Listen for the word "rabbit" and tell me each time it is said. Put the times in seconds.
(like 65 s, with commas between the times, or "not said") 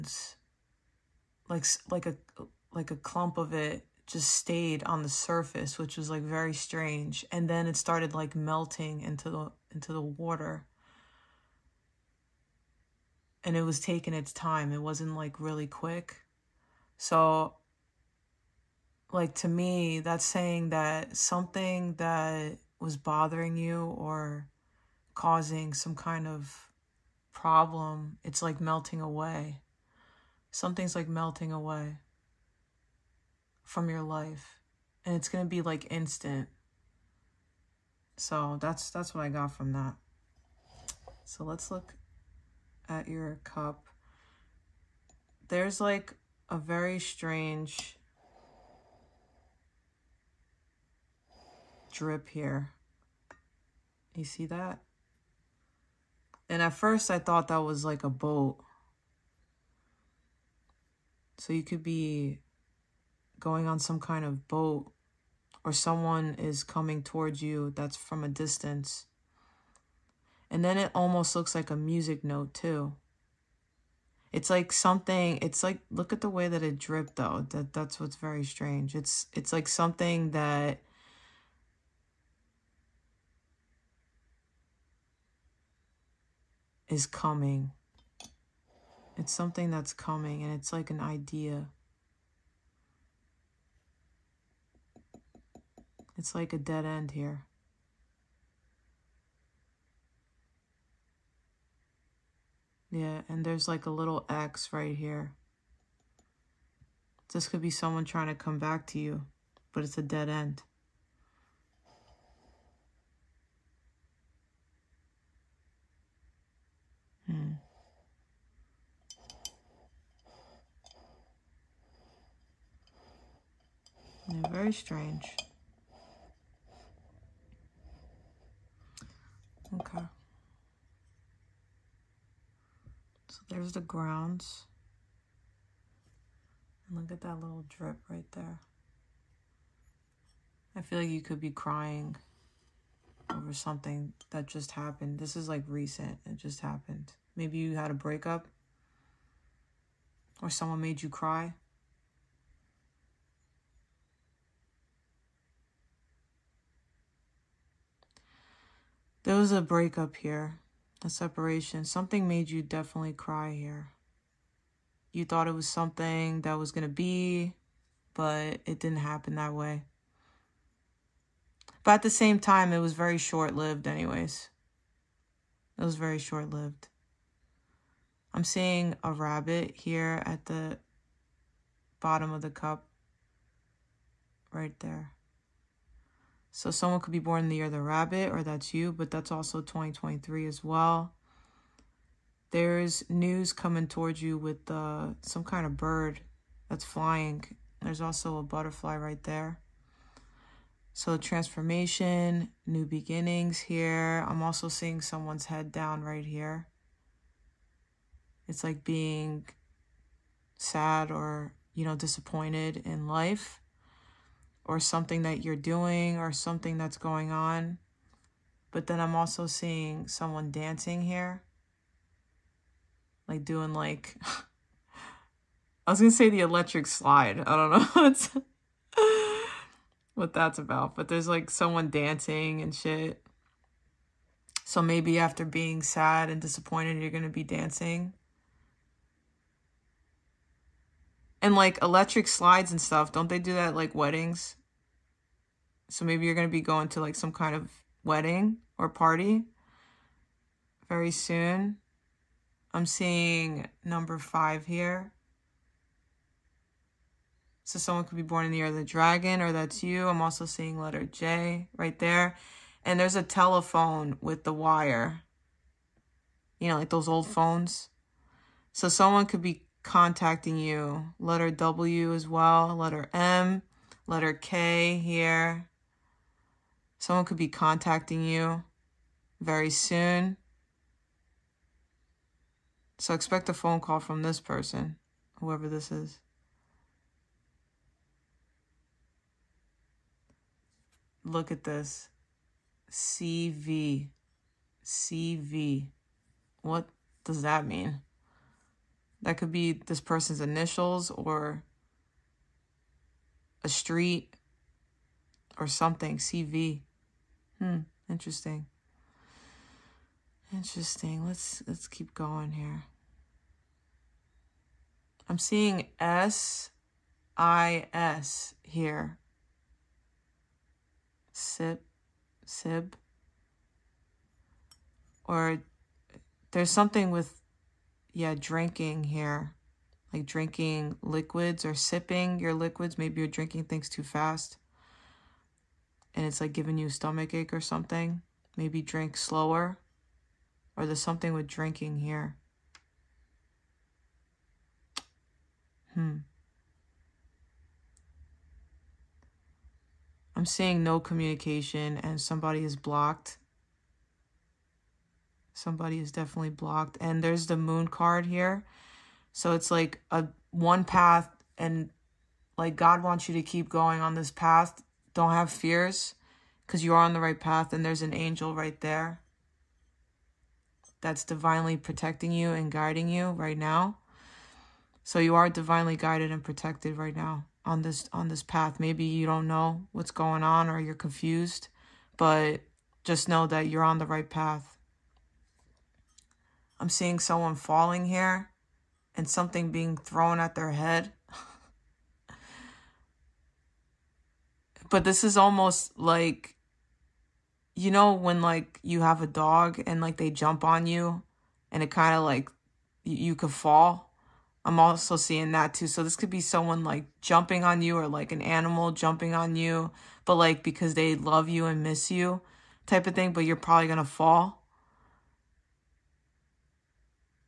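179 s, 187 s.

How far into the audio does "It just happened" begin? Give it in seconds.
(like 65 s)
146 s.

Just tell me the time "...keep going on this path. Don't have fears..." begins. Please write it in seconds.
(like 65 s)
363 s.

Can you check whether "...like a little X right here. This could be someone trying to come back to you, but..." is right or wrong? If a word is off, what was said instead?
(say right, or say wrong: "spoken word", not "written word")
right.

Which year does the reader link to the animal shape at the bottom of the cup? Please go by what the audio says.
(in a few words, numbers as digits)
2023.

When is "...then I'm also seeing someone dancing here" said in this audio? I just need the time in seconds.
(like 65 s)
218 s.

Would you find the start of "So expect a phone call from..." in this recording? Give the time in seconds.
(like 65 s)
282 s.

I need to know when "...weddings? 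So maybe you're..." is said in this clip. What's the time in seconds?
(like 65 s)
243 s.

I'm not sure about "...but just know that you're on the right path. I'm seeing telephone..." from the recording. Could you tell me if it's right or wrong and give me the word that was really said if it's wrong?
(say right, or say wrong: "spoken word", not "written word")
wrong: "someone", not "telephone".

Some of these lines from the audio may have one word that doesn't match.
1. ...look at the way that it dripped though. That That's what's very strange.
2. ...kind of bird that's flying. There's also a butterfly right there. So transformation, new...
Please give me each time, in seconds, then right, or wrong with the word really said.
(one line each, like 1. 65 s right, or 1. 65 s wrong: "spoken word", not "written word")
1. 75 s right
2. 195 s right.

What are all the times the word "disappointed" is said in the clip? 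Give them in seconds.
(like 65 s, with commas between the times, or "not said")
211 s, 236 s.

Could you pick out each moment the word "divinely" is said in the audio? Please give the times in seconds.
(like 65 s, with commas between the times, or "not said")
371 s, 375 s.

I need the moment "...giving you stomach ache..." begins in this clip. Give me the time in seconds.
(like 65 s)
336 s.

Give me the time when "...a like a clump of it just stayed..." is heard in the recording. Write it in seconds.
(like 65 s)
2 s.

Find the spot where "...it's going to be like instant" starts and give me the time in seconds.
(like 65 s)
35 s.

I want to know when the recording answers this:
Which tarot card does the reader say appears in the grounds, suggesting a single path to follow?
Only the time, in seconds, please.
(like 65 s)
357 s.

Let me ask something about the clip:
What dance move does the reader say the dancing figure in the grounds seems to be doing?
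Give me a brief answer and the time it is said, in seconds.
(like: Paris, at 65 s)
the electric slide, at 226 s.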